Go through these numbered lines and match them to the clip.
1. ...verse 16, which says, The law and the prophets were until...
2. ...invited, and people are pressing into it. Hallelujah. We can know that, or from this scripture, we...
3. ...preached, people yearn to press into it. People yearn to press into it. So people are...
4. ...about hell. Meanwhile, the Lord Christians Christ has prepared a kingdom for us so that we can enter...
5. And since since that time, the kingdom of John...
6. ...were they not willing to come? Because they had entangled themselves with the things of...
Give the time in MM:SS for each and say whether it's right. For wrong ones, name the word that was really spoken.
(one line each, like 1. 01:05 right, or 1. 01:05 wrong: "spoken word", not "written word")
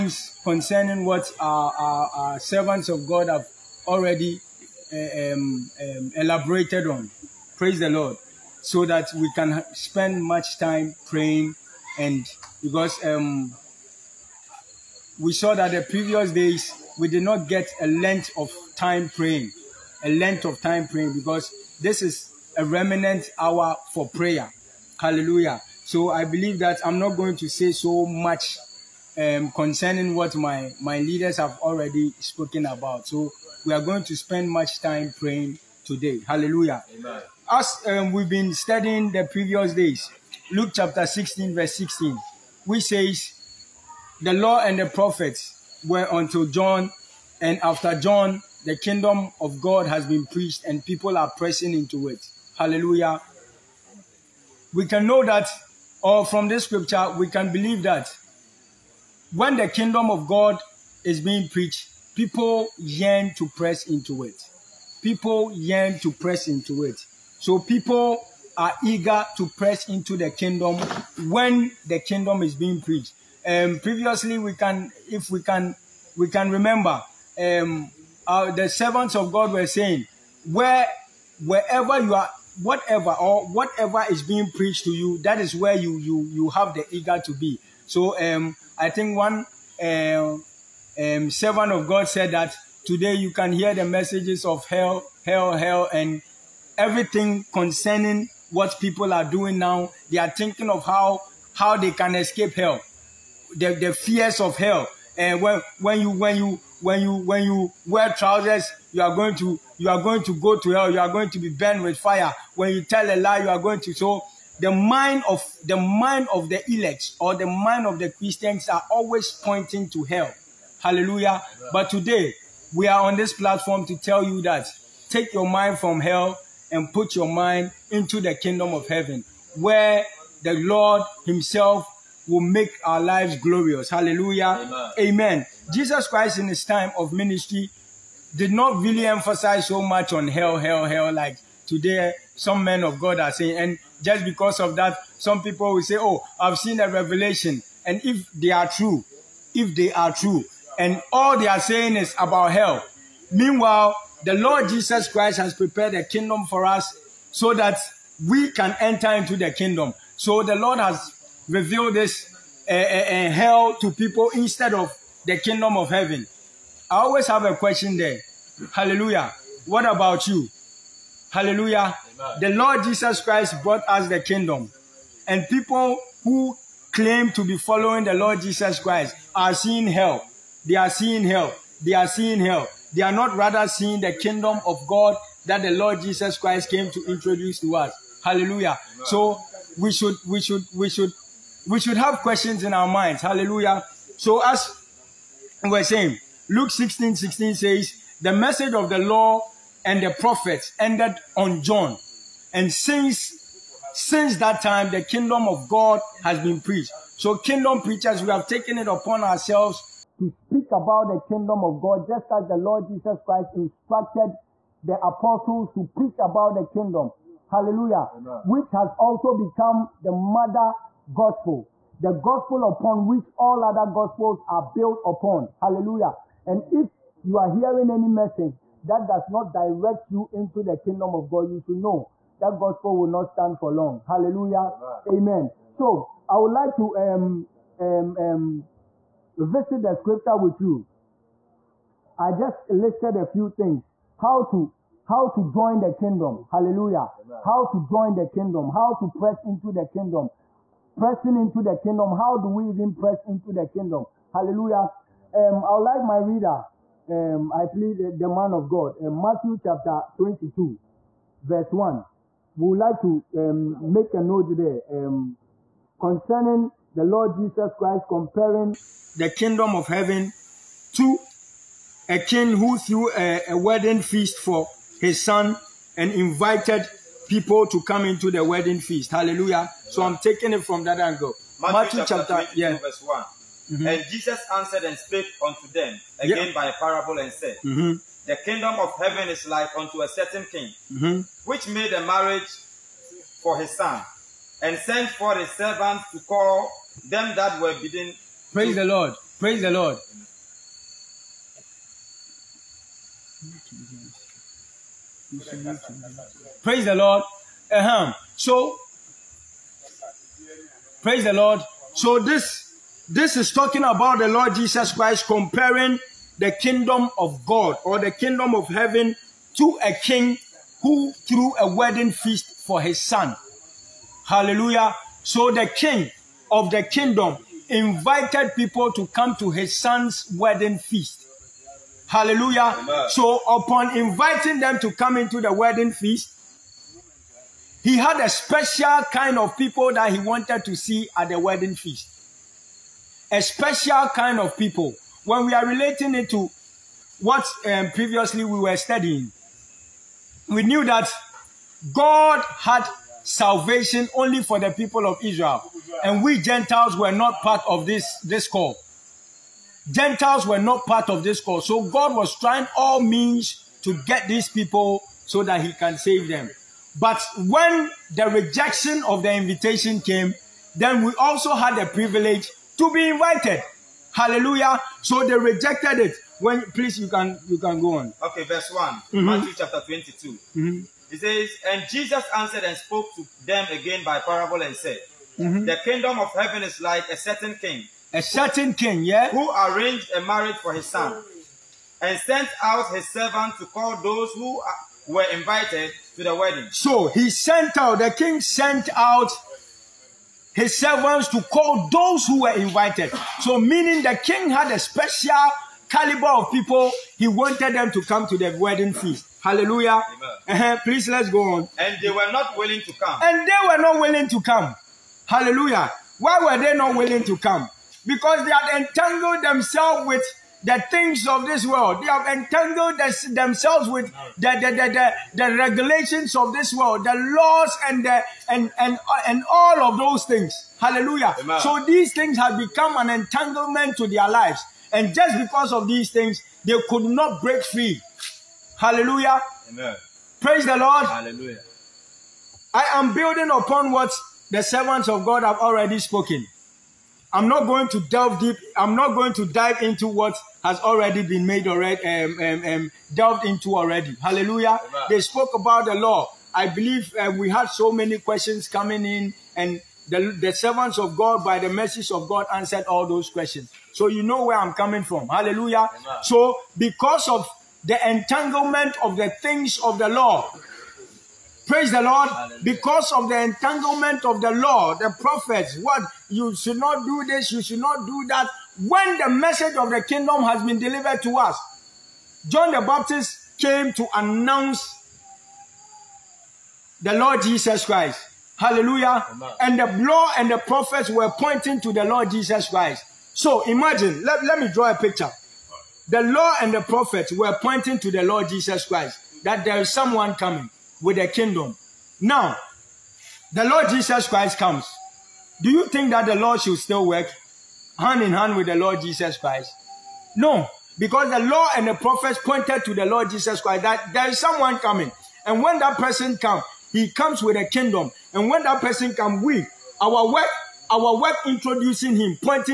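1. 00:41 right
2. 00:50 wrong: "preached", not "invited"
3. 01:01 right
4. 02:32 wrong: "Jesus", not "Christians"
5. 03:22 wrong: "God", not "John"
6. 06:56 right.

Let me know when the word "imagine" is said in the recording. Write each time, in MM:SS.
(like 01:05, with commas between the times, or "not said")
08:13.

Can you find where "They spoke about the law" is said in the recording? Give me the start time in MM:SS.
07:35.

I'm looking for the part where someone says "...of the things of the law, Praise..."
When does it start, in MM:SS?
07:49.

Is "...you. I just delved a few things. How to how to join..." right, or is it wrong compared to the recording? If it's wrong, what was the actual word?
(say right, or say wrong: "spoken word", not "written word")
wrong: "listed", not "delved".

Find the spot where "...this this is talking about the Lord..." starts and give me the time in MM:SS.
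05:12.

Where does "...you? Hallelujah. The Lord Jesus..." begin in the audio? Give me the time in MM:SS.
02:50.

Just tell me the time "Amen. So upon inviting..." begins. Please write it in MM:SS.
05:32.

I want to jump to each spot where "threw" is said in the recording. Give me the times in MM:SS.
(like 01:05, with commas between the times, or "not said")
04:32, 05:21.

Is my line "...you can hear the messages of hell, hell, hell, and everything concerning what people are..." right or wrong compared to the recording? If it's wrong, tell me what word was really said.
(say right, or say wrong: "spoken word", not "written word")
right.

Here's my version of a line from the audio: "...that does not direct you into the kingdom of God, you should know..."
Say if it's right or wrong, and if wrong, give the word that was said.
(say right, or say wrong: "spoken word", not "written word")
right.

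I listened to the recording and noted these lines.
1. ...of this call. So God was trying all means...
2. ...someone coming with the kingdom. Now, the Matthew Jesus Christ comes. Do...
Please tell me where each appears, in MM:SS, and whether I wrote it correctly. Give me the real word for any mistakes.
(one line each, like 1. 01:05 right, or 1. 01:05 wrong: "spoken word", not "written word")
1. 06:01 right
2. 08:19 wrong: "Lord", not "Matthew".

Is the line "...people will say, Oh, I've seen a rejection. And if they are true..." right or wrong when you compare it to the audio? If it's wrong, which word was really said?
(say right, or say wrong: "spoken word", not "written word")
wrong: "revelation", not "rejection".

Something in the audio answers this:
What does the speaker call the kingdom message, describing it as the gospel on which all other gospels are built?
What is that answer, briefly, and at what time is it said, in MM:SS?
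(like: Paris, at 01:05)
The mother gospel, at 03:40.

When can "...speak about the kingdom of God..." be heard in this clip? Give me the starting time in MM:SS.
03:30.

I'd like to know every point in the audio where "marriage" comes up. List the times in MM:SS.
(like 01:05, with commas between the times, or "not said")
04:52, 06:30.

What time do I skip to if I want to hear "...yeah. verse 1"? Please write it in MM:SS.
04:42.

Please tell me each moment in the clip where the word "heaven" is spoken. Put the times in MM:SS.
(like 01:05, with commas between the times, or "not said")
02:08, 02:45, 04:29, 04:48, 05:18, 06:26.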